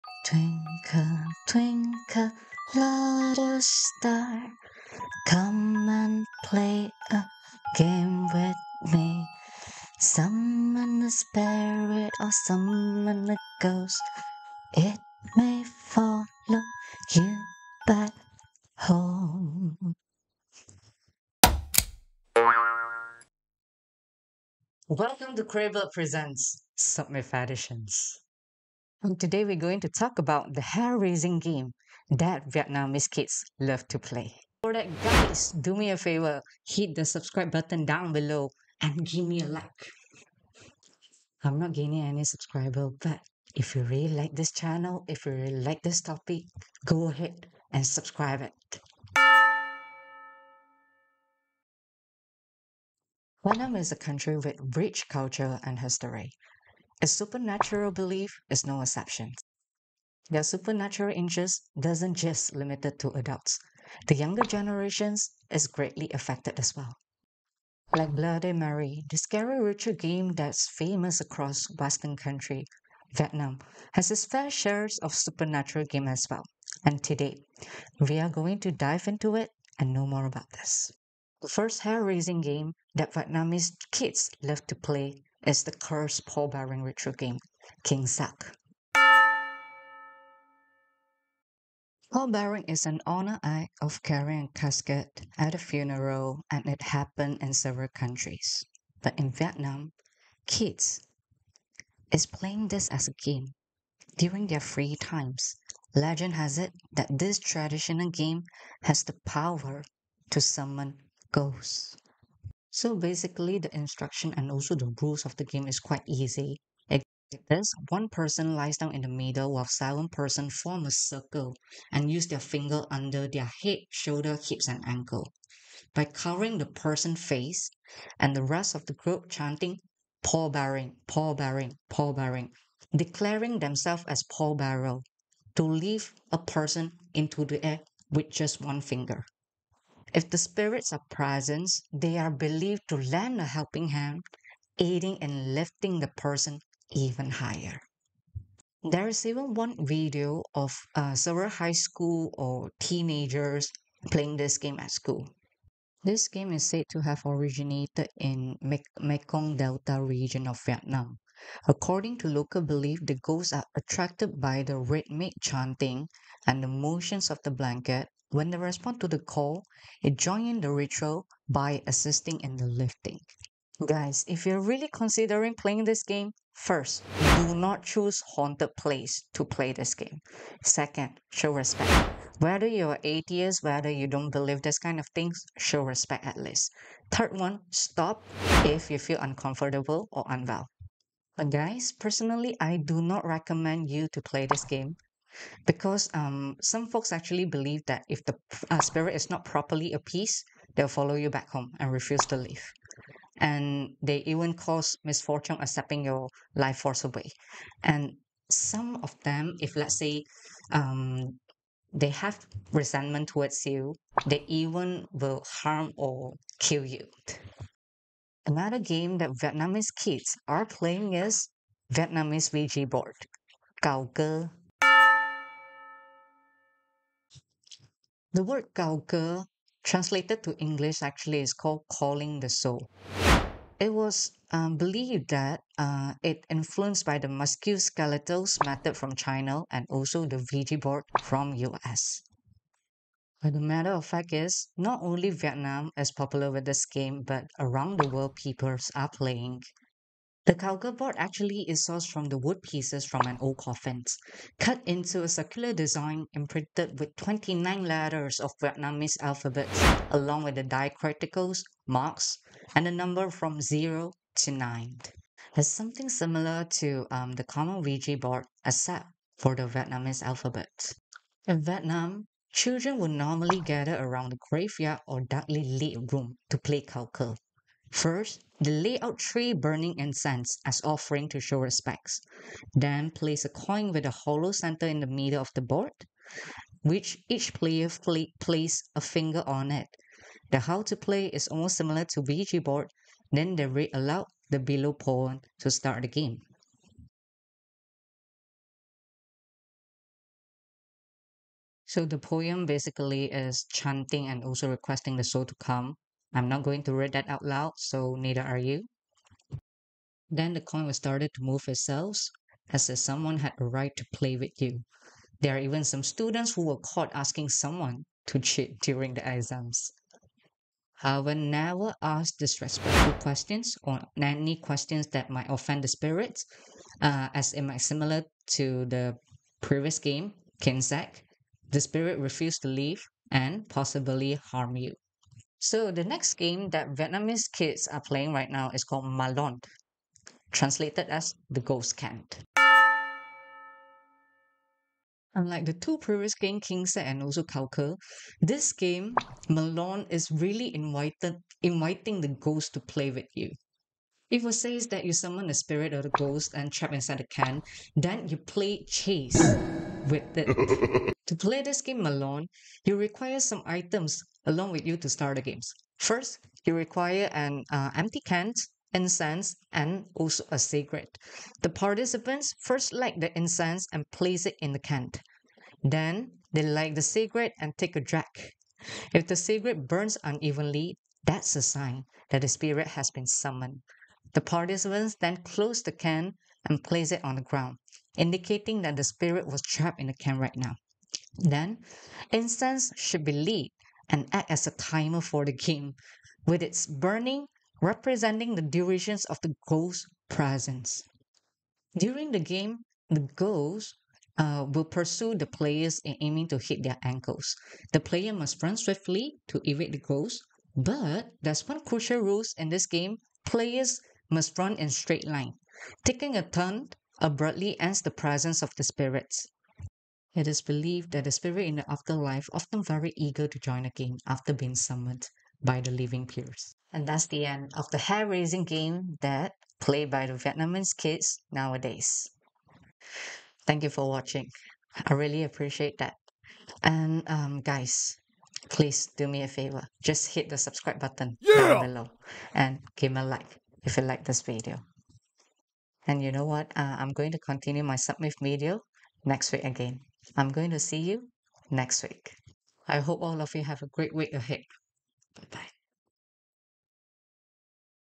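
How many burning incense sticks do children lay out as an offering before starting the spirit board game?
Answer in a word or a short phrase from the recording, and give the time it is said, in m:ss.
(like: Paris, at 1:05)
3, at 4:39.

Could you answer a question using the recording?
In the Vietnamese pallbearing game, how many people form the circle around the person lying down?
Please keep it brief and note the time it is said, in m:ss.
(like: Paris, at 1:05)
7, at 1:59.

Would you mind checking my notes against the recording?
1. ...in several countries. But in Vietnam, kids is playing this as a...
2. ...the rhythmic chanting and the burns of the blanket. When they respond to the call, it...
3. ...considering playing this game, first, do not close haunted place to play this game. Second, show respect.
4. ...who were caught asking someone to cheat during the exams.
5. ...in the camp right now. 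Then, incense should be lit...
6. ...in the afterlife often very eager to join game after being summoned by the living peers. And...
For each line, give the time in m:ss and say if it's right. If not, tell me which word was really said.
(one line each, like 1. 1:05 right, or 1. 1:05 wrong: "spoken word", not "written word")
1. 1:37 right
2. 2:44 wrong: "motions", not "burns"
3. 2:54 wrong: "choose", not "close"
4. 5:16 right
5. 6:29 right
6. 7:01 right.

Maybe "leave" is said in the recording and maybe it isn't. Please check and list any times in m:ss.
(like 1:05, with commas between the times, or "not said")
3:22, 5:32.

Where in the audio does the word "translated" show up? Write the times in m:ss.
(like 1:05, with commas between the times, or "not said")
3:49, 5:40.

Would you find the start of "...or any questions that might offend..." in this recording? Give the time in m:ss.
5:23.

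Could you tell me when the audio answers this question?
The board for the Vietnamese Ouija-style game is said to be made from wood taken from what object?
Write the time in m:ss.
4:13.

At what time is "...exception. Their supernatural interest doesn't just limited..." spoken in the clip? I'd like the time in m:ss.
0:58.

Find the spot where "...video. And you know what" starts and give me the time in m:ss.
7:24.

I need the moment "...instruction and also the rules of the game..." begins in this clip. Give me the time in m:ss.
1:53.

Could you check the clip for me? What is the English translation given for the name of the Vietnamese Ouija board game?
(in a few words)
Calling the soul.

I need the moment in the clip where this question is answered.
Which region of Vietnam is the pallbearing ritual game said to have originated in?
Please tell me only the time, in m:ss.
2:38.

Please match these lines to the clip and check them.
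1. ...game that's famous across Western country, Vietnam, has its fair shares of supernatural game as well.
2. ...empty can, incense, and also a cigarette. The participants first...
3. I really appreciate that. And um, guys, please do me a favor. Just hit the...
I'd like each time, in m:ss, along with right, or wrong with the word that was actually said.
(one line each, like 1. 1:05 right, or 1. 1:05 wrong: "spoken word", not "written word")
1. 1:09 right
2. 6:07 right
3. 7:15 right.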